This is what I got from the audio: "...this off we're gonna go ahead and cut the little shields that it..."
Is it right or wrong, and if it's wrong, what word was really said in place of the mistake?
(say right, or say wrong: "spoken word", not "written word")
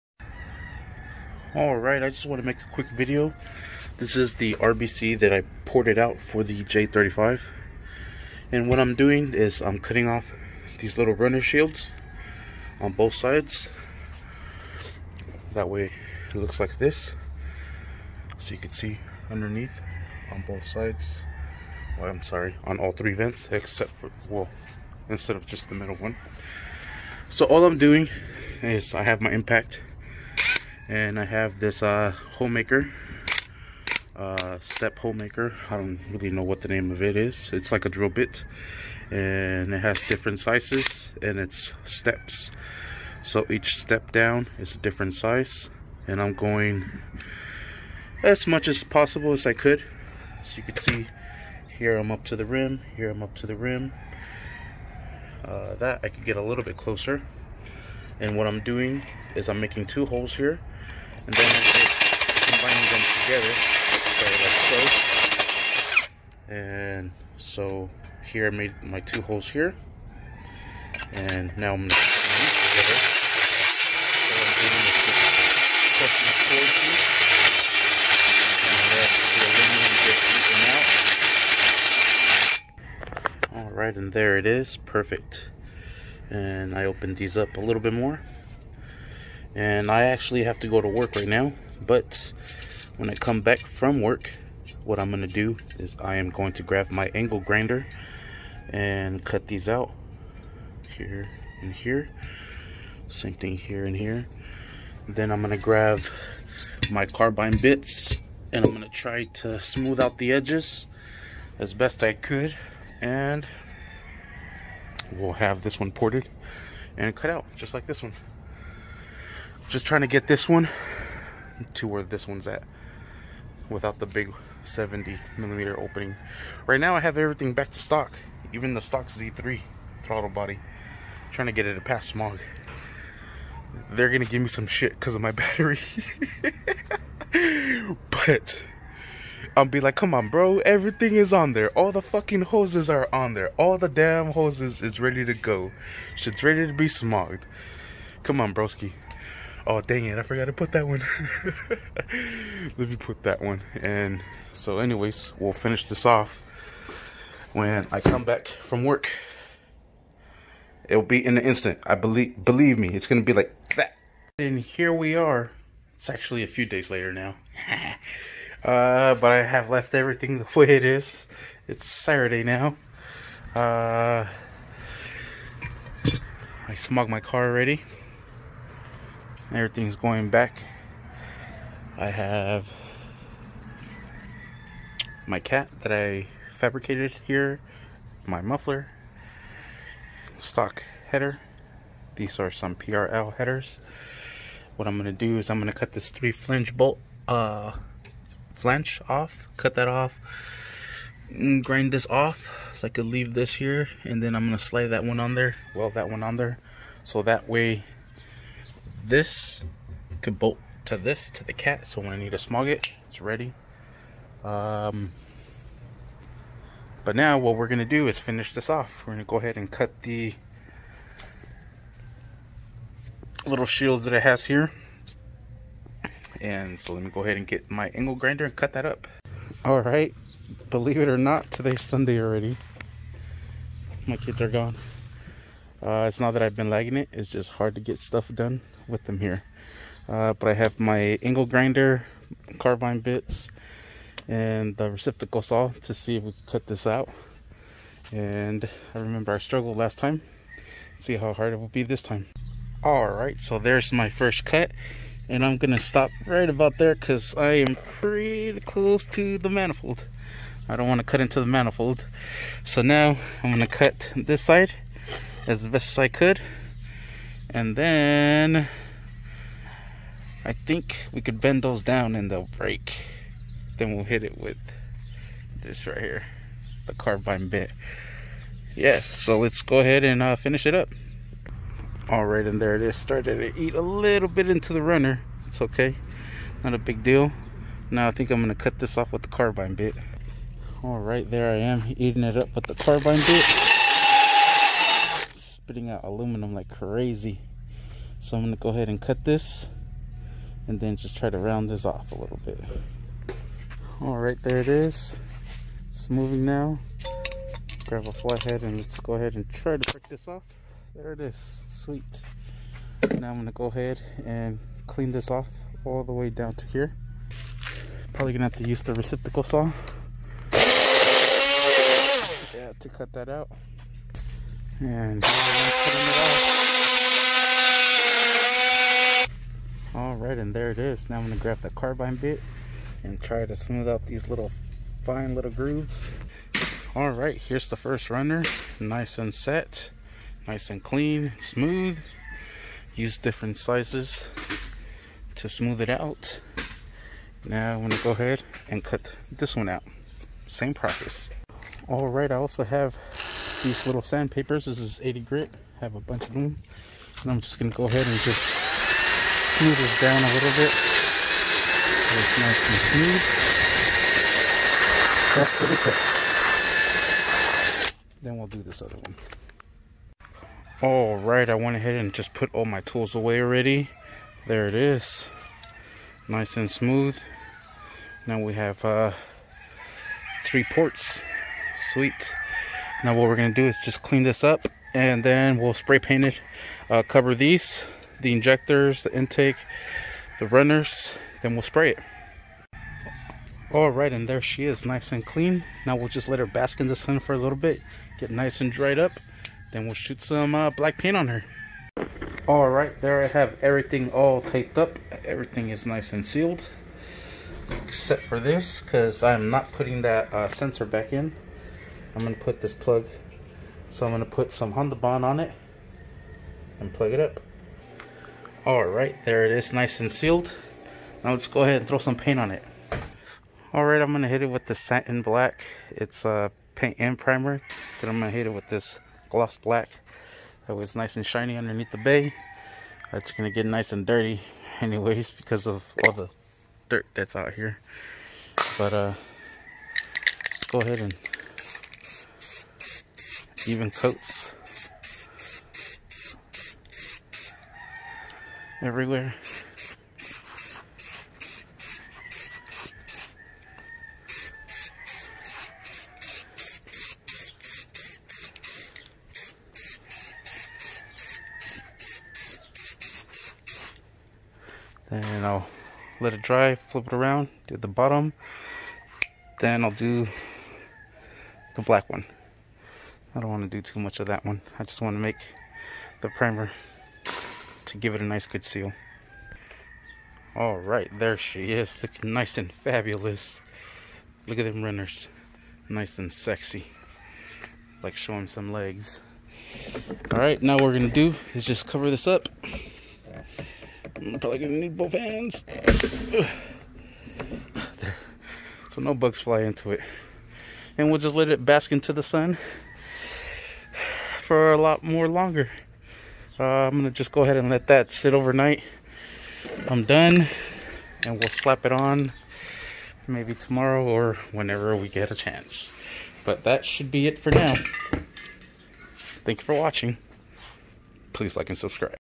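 right.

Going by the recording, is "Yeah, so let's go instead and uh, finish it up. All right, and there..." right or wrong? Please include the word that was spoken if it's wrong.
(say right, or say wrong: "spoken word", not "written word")
wrong: "ahead", not "instead".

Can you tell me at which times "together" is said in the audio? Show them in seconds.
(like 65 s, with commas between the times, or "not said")
63 s, 72 s.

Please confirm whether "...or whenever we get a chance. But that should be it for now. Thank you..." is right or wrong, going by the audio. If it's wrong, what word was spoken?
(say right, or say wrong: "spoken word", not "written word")
right.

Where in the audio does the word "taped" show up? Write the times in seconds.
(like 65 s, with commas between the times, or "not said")
404 s.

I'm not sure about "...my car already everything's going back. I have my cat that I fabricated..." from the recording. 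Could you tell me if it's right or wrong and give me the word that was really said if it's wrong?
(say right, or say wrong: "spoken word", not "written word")
right.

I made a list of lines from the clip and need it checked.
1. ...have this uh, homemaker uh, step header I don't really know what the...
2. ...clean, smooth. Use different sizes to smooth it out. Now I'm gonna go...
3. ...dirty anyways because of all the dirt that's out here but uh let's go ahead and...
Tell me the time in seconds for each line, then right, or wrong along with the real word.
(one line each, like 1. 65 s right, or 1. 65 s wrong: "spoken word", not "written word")
1. 31 s wrong: "homemaker", not "header"
2. 340 s right
3. 434 s right.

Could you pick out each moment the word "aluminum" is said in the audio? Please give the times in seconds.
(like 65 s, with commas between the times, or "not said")
79 s, 296 s.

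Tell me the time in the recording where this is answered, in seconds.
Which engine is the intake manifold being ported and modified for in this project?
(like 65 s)
6 s.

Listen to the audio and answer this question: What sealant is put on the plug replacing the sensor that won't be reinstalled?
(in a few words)
Honda Bond.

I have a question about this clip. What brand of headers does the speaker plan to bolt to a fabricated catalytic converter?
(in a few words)
PRL.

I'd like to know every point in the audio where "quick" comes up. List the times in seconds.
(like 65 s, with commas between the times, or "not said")
2 s, 365 s.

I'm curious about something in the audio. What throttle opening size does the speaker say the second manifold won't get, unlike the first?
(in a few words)
70 millimeter.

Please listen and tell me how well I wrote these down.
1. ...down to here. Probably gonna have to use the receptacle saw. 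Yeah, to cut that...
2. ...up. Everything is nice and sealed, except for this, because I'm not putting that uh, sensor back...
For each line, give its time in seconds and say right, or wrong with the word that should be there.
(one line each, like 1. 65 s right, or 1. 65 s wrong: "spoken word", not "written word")
1. 316 s right
2. 404 s right.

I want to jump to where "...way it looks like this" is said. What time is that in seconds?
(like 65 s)
15 s.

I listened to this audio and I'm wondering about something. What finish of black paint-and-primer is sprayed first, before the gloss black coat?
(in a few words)
Satin black.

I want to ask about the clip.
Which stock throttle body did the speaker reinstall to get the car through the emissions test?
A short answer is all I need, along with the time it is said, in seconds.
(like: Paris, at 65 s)
Z3, at 129 s.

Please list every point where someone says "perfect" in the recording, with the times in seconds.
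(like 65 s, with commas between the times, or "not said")
84 s.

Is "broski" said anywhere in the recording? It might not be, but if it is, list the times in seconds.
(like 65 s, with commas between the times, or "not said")
148 s.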